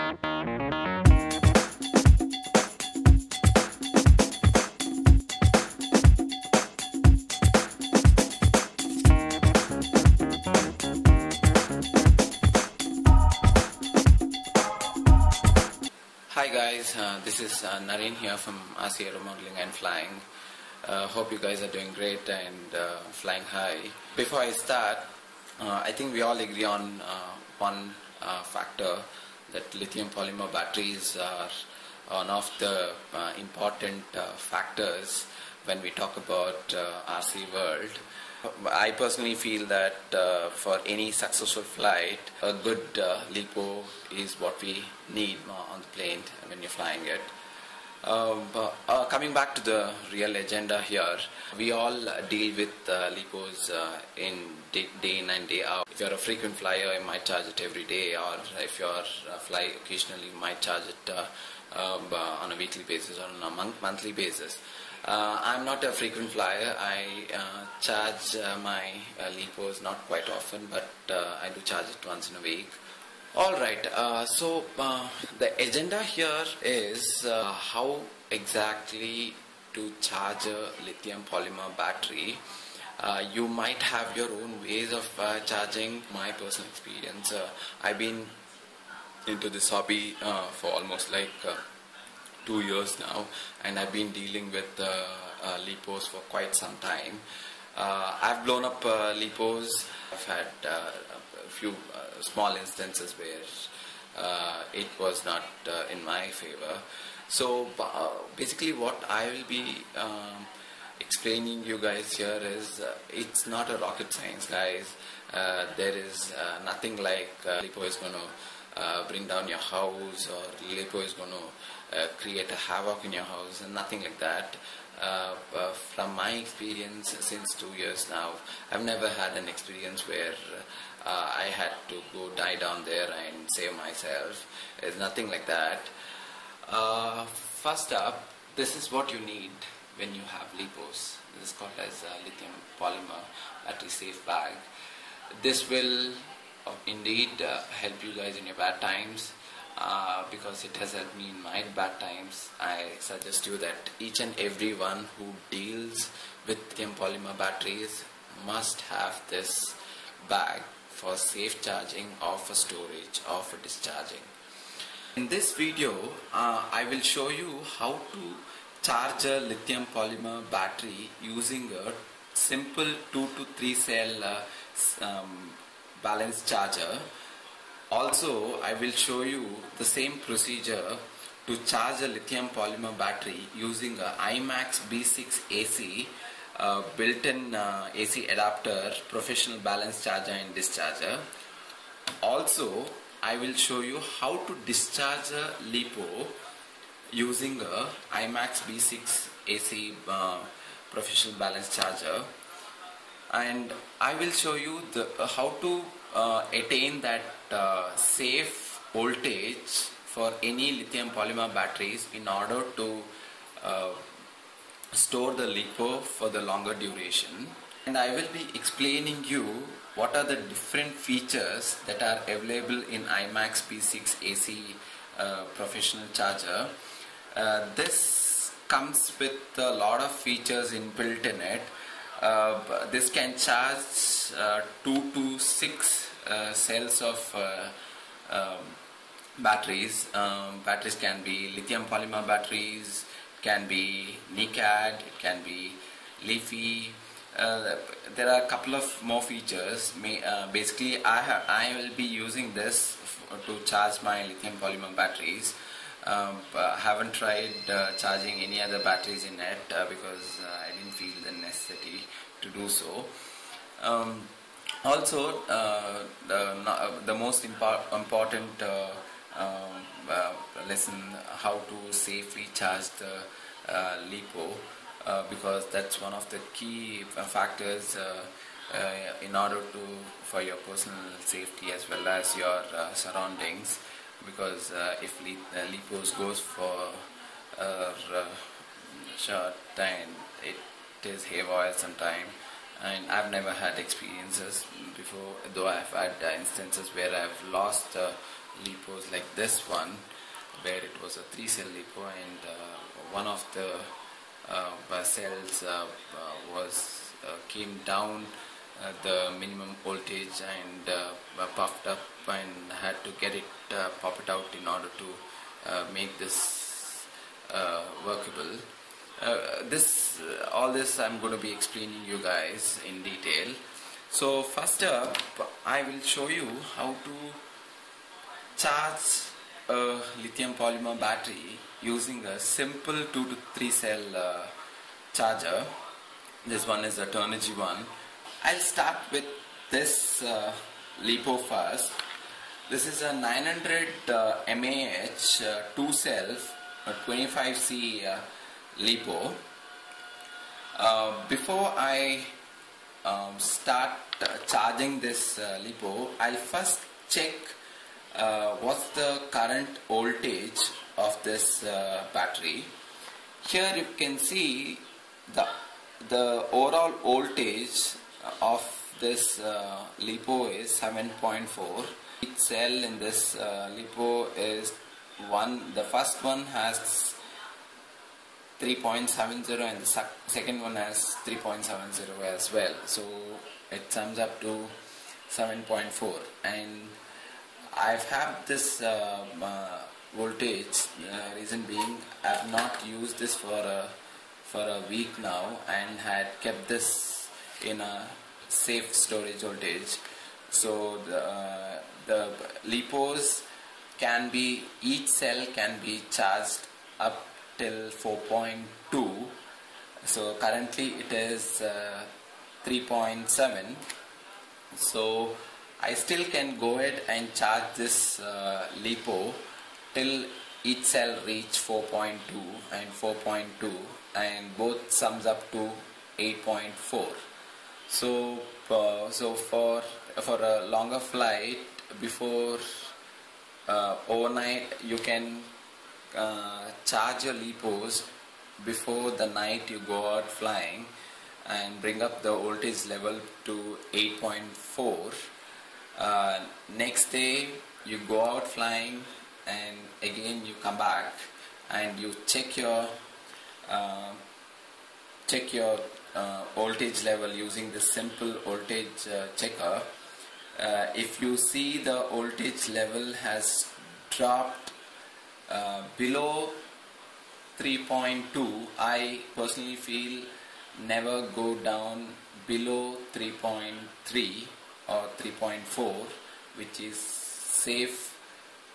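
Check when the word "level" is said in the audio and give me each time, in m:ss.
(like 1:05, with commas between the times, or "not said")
7:22, 7:37, 7:42.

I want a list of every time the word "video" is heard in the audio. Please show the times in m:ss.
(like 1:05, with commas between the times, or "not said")
2:45.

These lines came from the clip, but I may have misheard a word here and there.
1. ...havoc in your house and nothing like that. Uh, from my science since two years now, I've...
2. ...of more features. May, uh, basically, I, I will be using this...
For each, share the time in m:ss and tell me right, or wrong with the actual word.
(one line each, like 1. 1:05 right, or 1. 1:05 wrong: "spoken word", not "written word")
1. 2:02 wrong: "experience", not "science"
2. 4:08 right.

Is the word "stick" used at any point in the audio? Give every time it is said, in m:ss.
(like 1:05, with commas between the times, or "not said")
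not said.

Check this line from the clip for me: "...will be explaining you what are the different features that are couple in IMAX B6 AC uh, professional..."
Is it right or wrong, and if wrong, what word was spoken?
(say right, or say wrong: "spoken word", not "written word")
wrong: "available", not "couple".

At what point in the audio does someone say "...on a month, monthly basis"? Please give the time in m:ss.
1:03.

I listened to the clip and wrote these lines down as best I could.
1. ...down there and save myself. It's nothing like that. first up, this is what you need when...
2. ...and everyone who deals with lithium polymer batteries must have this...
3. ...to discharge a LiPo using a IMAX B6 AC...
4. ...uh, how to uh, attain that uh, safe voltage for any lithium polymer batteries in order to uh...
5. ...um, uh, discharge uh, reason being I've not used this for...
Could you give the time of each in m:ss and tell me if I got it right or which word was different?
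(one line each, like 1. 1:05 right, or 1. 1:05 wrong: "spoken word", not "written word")
1. 2:12 right
2. 2:34 right
3. 3:14 right
4. 3:25 right
5. 6:28 wrong: "voltage", not "discharge".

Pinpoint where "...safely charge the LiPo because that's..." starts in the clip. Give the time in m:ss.
4:31.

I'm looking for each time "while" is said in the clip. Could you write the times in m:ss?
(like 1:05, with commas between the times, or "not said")
not said.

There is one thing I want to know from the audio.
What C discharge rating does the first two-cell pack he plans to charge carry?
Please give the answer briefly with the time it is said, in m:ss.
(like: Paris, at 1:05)
25C, at 5:47.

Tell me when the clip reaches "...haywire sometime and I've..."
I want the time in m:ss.
4:51.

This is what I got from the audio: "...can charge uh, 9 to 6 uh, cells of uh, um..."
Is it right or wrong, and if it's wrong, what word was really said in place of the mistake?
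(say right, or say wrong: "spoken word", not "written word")
wrong: "2", not "9".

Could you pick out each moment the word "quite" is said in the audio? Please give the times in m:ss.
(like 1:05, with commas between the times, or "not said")
1:10, 1:36.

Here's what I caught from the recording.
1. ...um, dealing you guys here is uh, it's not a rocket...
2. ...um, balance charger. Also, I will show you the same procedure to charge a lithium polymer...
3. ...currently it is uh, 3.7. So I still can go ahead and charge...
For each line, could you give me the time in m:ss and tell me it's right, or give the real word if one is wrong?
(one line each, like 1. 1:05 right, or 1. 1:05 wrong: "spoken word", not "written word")
1. 1:49 wrong: "explaining", not "dealing"
2. 2:55 right
3. 6:50 right.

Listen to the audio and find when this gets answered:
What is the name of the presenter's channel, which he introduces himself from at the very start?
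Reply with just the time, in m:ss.
0:18.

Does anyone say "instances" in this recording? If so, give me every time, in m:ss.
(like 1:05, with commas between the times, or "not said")
1:42, 4:56.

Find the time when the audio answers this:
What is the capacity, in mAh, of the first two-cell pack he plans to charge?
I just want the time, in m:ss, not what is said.
5:43.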